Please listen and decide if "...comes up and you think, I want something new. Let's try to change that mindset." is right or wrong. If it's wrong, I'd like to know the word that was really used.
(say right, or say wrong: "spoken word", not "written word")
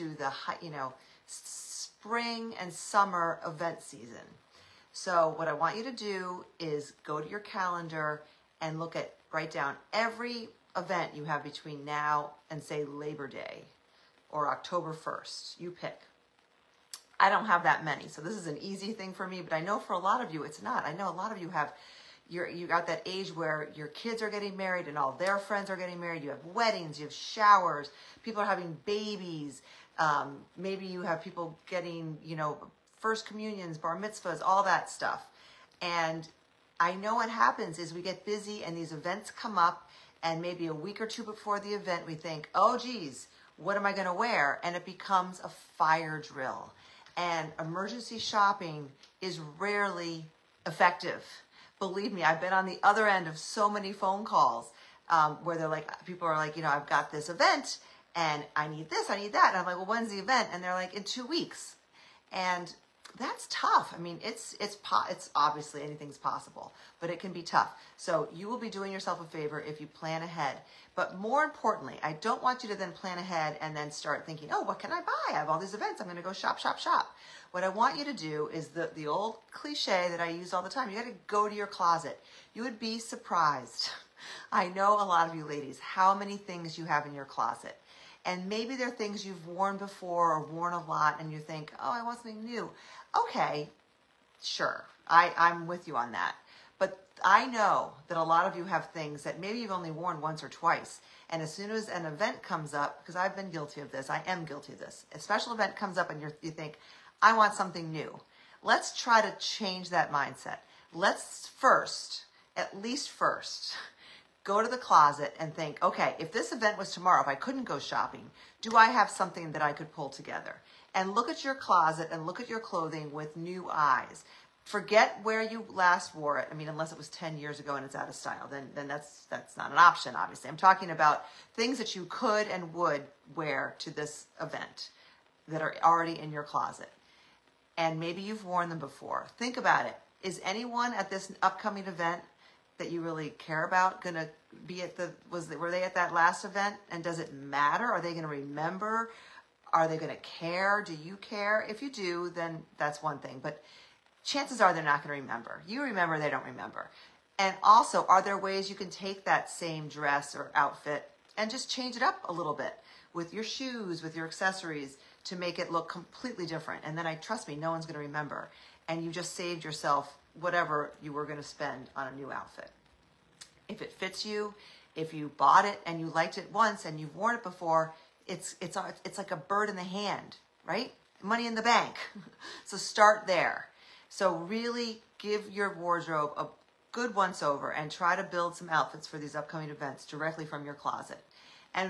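right.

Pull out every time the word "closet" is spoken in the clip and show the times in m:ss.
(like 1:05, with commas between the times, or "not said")
1:21, 1:27, 1:54, 2:01, 2:16, 3:10.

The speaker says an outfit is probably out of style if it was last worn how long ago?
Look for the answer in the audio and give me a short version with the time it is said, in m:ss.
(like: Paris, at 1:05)
10 years ago, at 2:07.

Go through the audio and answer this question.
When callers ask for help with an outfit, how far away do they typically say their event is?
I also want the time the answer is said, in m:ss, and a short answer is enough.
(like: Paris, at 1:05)
Two weeks, at 1:00.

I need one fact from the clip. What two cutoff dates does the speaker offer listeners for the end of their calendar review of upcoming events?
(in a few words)
Labor Day or October 1st.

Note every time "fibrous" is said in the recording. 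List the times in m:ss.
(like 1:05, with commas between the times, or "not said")
not said.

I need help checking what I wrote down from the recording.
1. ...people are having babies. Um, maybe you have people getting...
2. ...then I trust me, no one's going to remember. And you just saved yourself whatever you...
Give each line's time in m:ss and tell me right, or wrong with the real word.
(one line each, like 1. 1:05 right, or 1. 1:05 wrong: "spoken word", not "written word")
1. 0:28 right
2. 2:46 right.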